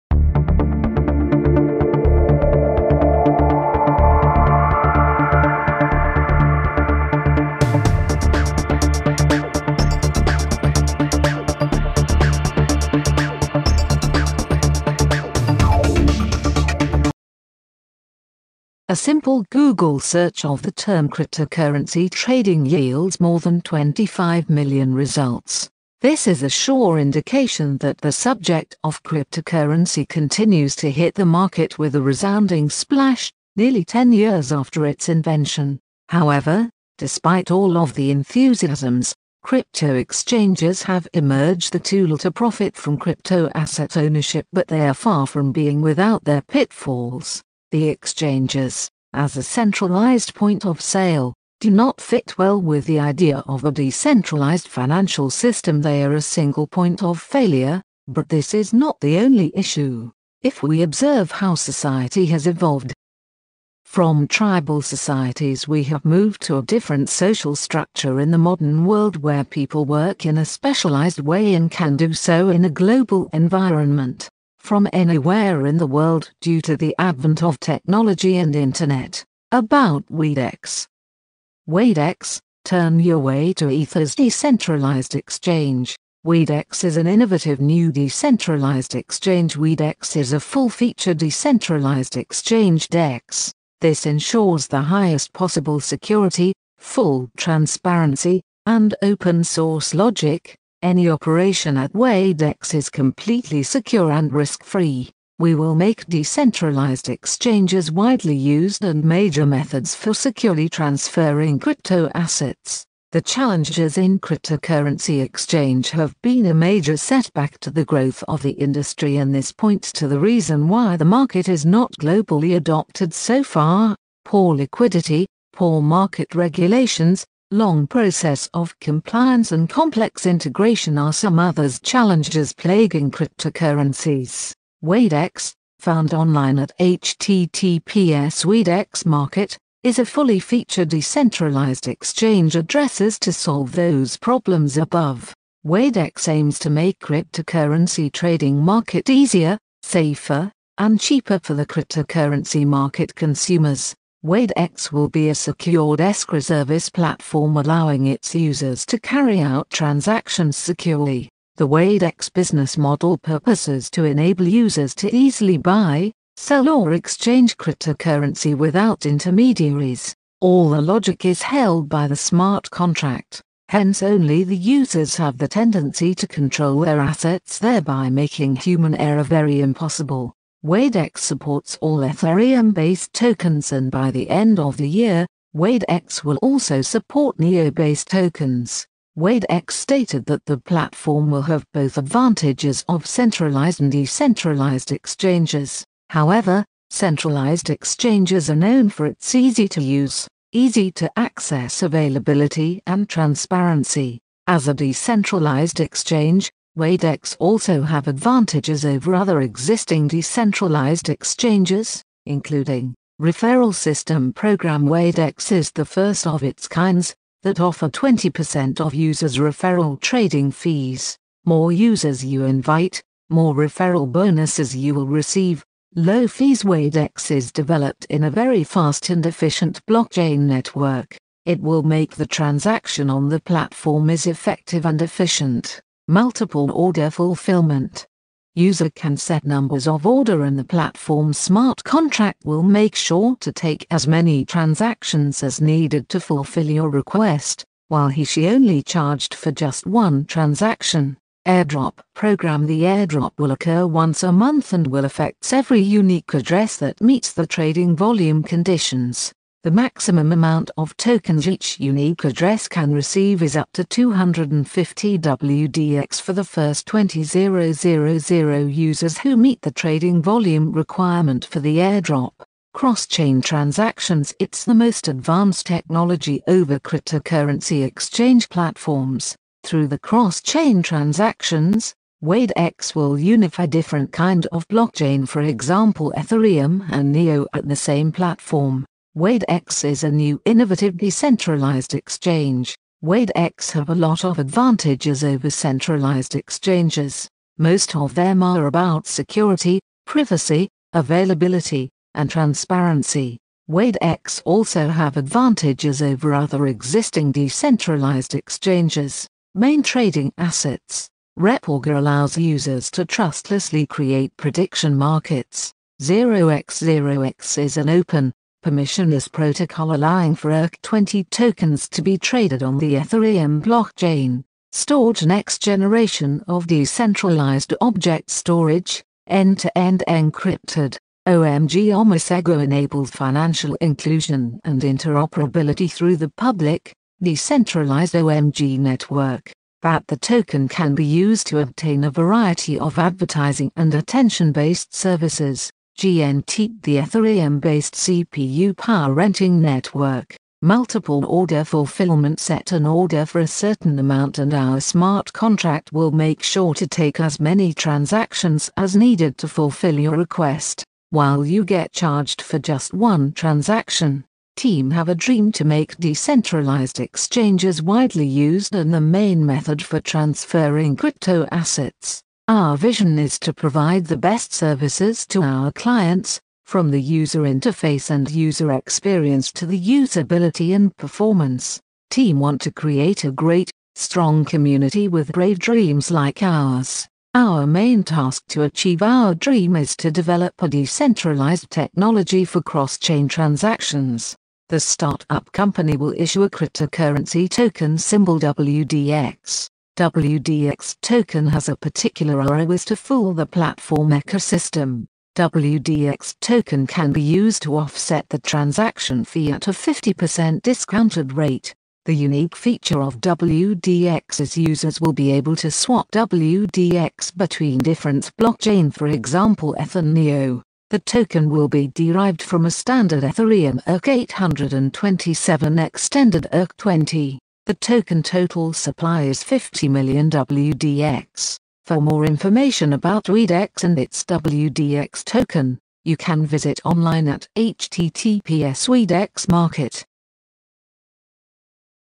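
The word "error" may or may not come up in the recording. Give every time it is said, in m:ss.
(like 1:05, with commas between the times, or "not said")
2:58.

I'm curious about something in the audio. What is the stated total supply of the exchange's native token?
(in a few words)
50 million WDX.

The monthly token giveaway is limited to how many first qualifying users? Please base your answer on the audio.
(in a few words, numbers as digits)
20,000.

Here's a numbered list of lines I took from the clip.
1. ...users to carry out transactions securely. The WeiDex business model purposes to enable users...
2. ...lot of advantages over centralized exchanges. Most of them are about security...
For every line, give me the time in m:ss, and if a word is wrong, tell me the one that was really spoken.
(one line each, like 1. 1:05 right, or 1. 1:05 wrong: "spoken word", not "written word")
1. 2:38 right
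2. 4:53 right.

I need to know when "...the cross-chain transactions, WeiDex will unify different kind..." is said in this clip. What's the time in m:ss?
4:39.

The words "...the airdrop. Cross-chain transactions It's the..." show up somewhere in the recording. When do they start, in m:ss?
4:31.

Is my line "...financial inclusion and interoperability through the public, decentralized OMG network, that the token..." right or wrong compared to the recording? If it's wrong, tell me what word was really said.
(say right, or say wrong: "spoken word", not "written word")
right.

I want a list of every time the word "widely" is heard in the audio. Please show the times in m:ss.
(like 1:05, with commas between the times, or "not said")
1:47, 6:07.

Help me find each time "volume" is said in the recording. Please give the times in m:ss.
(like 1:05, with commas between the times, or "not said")
4:17, 4:30.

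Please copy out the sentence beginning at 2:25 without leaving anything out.
WeiDex aims to make cryptocurrency trading market easier, safer, and cheaper for the cryptocurrency market consumers.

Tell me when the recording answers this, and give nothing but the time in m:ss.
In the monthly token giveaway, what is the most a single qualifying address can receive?
4:23.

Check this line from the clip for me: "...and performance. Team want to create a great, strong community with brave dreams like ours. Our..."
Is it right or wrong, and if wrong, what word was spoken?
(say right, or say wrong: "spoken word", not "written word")
right.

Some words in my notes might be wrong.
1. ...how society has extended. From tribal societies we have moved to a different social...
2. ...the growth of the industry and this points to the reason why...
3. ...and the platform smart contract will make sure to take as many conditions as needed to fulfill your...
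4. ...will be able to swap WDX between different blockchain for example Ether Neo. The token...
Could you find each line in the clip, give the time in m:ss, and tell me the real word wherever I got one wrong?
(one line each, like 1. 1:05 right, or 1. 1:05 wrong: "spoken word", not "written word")
1. 1:01 wrong: "evolved", not "extended"
2. 1:57 right
3. 4:00 wrong: "transactions", not "conditions"
4. 6:55 right.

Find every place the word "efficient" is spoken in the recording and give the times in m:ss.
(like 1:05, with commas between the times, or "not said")
3:49, 3:55.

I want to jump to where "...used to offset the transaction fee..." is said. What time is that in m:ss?
6:47.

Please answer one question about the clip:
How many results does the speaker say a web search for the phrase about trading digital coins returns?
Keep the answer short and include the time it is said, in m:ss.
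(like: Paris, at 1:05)
more than 25 million, at 0:23.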